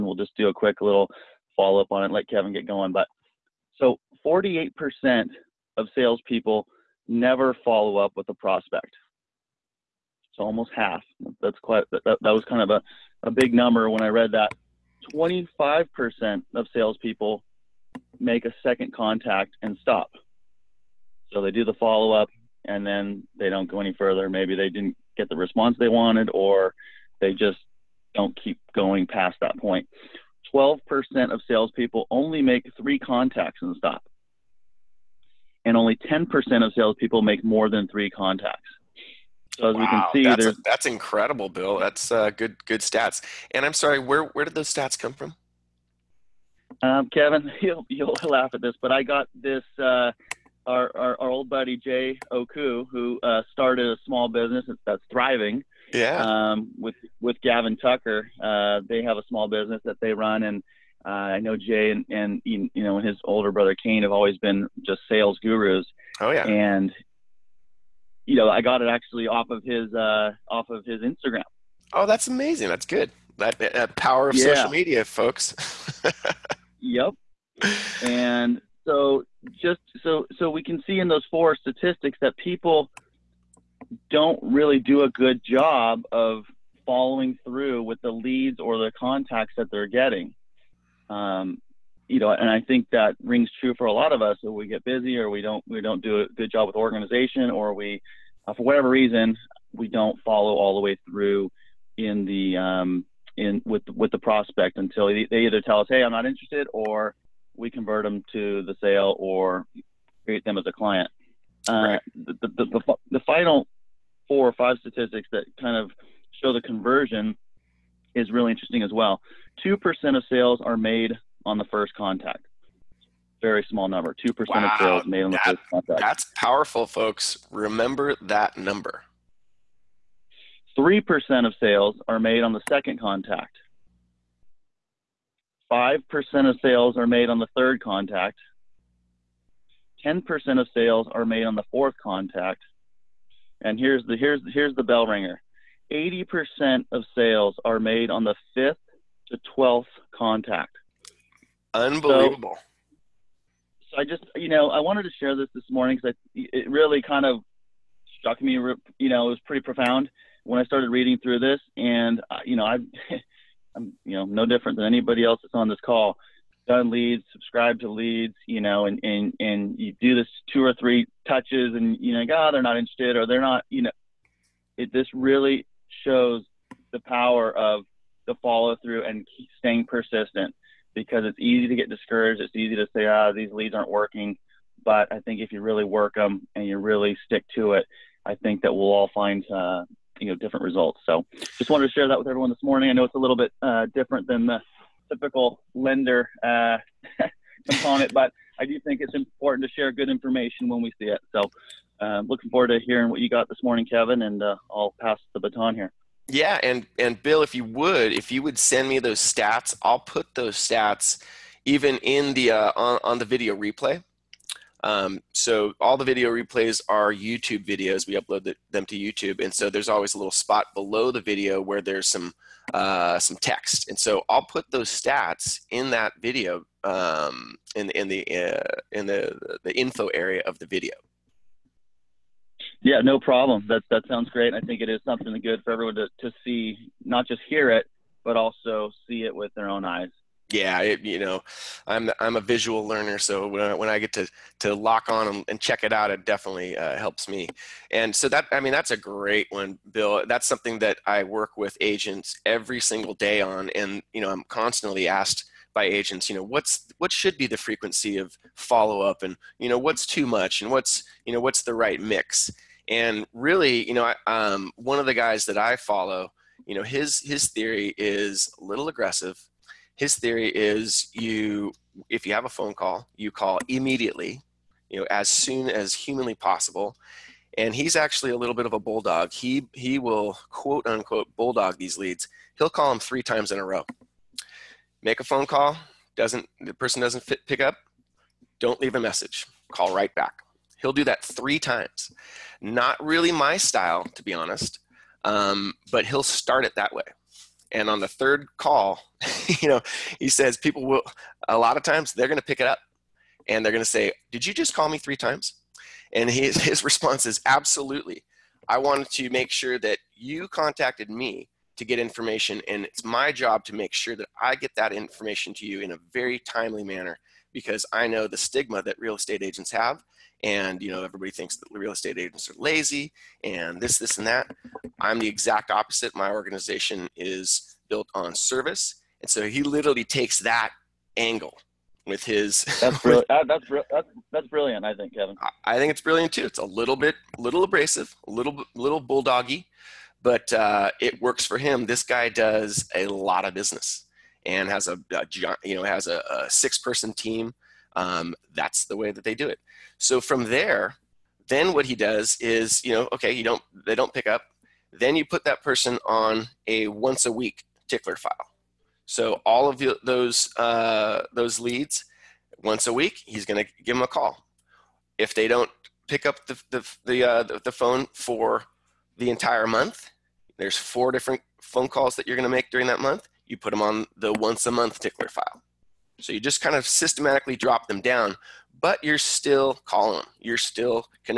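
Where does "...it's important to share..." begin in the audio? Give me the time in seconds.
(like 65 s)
199 s.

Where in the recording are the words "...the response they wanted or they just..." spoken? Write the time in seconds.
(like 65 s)
25 s.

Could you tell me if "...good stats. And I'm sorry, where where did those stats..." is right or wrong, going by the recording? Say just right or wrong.
right.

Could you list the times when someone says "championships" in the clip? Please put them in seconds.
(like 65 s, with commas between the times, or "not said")
not said.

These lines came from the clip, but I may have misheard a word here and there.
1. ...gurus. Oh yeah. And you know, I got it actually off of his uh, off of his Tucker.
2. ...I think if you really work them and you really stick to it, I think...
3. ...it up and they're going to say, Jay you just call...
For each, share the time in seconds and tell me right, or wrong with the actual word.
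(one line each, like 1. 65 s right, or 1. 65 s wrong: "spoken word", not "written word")
1. 65 s wrong: "Instagram", not "Tucker"
2. 185 s right
3. 302 s wrong: "Did", not "Jay".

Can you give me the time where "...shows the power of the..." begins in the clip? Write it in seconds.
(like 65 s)
176 s.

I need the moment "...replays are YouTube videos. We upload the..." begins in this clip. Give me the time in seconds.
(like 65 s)
216 s.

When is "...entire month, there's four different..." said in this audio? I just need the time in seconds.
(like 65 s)
369 s.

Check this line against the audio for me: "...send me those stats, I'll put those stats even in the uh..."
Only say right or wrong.
right.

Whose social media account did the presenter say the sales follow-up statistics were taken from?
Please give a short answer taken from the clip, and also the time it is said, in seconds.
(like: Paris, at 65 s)
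Jay Oku, at 51 s.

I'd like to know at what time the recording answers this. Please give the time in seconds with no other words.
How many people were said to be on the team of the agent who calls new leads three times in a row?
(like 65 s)
346 s.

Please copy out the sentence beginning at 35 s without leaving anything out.
And only 10% of salespeople make more than three contacts.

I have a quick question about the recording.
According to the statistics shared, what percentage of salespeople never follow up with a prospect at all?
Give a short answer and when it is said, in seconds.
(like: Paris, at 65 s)
48%, at 4 s.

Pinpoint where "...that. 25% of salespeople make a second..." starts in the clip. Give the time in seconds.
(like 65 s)
14 s.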